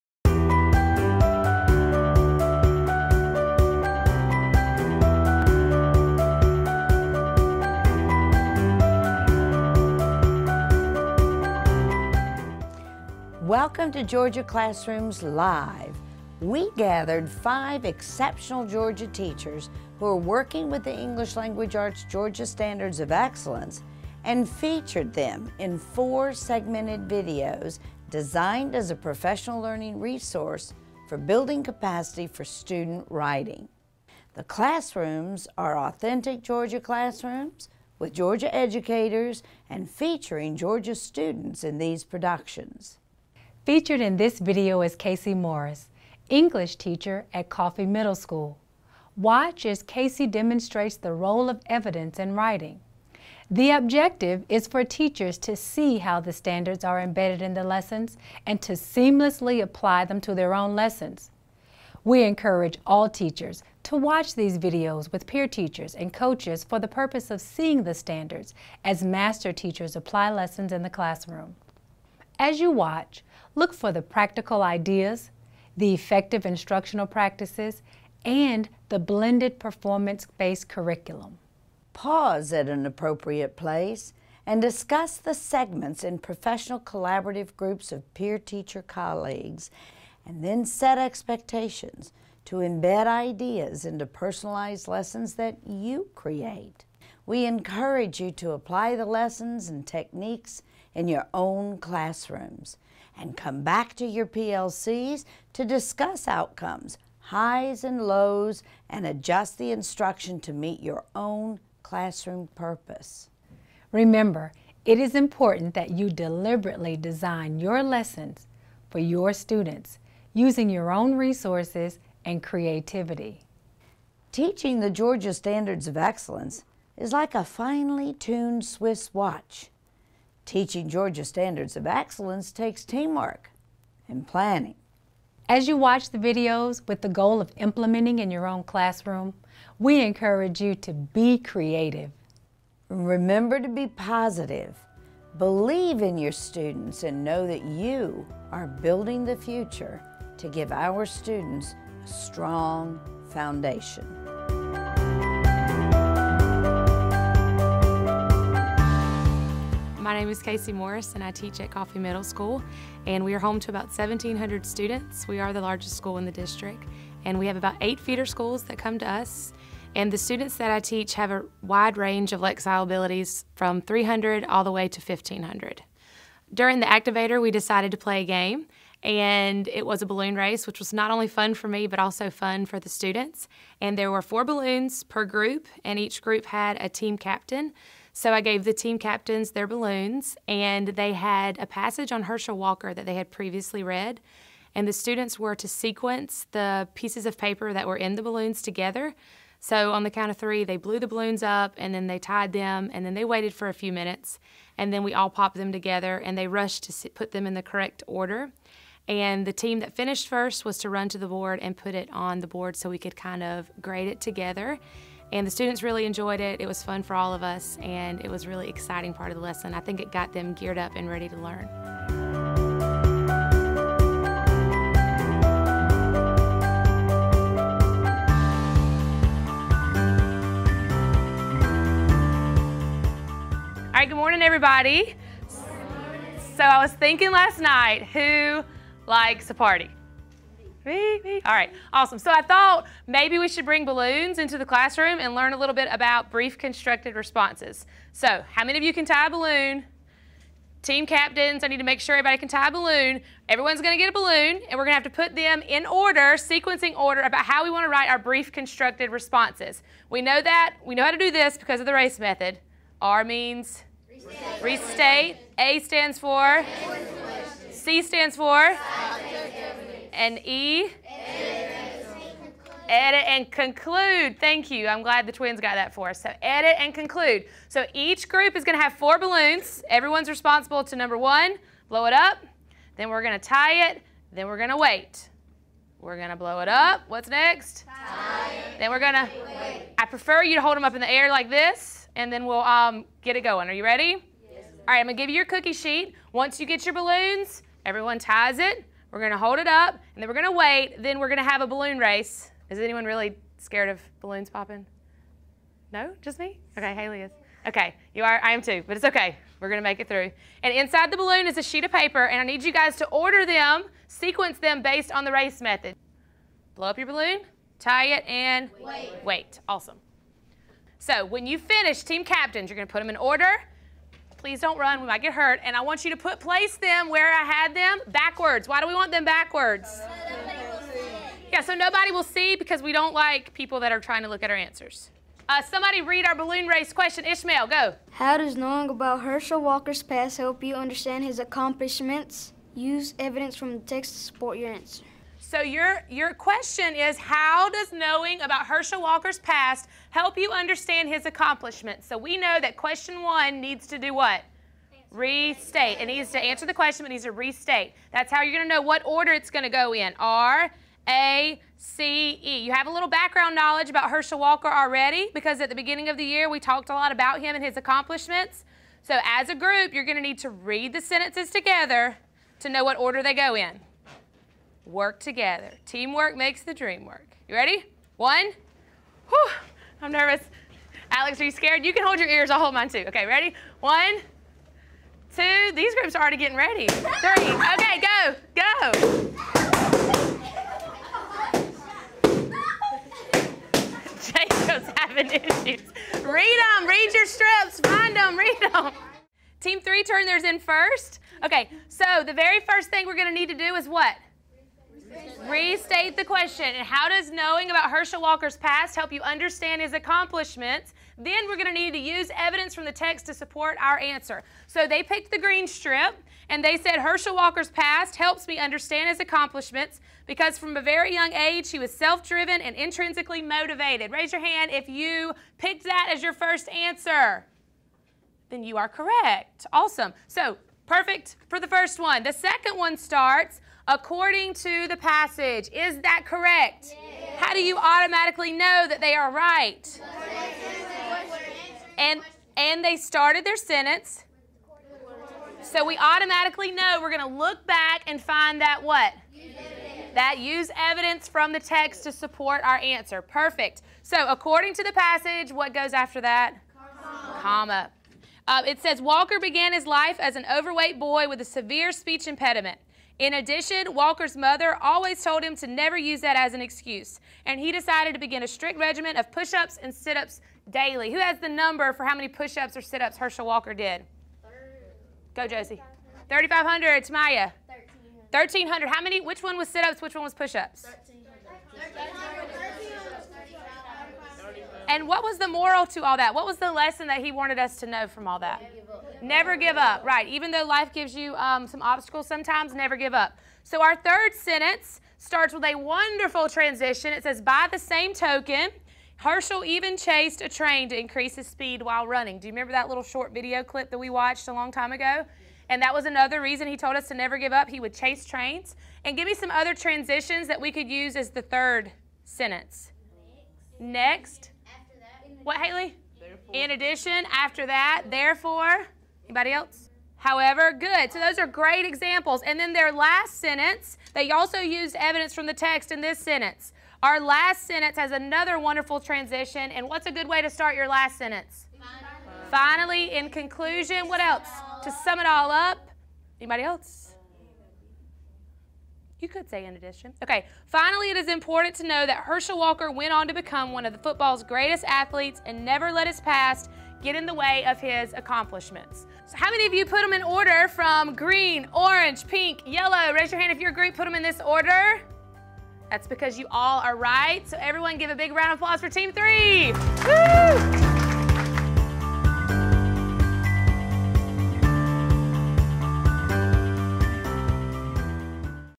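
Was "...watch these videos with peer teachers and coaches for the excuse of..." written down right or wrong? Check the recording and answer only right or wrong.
wrong.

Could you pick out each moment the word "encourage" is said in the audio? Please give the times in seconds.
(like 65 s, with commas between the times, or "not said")
62 s, 97 s, 140 s.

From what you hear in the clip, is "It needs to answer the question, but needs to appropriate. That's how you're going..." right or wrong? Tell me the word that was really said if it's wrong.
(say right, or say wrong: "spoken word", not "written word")
wrong: "restate", not "appropriate".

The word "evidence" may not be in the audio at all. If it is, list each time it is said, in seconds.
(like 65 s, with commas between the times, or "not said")
51 s, 343 s, 412 s, 450 s, 524 s.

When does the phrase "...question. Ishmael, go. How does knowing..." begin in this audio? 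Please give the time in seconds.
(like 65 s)
336 s.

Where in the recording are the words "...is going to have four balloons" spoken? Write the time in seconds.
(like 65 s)
278 s.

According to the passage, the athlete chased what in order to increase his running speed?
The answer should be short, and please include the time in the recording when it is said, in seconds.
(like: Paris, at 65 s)
A train, at 500 s.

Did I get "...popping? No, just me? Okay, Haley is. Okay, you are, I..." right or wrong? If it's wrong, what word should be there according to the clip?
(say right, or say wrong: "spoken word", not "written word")
right.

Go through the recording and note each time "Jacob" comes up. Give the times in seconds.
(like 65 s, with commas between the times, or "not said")
394 s.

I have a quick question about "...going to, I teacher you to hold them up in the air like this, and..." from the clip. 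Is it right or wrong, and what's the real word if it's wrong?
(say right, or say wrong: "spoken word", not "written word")
wrong: "prefer", not "teacher".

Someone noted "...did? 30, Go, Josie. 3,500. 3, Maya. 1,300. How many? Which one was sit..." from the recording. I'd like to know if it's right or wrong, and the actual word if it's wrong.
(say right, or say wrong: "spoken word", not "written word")
right.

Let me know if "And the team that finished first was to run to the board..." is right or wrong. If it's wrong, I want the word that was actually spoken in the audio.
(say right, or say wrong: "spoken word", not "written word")
right.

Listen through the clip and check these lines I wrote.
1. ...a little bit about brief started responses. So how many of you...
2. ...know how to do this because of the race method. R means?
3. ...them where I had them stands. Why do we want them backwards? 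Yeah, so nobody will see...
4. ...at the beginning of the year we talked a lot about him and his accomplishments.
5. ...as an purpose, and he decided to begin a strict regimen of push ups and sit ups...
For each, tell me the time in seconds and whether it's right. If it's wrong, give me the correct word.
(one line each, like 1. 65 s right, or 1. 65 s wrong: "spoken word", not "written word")
1. 245 s wrong: "constructed", not "started"
2. 260 s right
3. 326 s wrong: "backwards", not "stands"
4. 365 s right
5. 466 s wrong: "excuse", not "purpose".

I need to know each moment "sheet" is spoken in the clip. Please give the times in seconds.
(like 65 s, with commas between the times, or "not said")
295 s, 311 s.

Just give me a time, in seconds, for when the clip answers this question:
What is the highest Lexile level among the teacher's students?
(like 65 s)
174 s.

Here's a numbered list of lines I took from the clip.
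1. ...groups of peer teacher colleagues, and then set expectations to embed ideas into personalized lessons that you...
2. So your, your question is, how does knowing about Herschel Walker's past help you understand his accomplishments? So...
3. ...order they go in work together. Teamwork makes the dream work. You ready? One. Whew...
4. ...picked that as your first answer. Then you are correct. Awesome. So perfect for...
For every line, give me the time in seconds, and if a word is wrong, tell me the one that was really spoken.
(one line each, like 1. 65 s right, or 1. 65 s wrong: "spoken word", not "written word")
1. 87 s right
2. 345 s right
3. 372 s right
4. 425 s right.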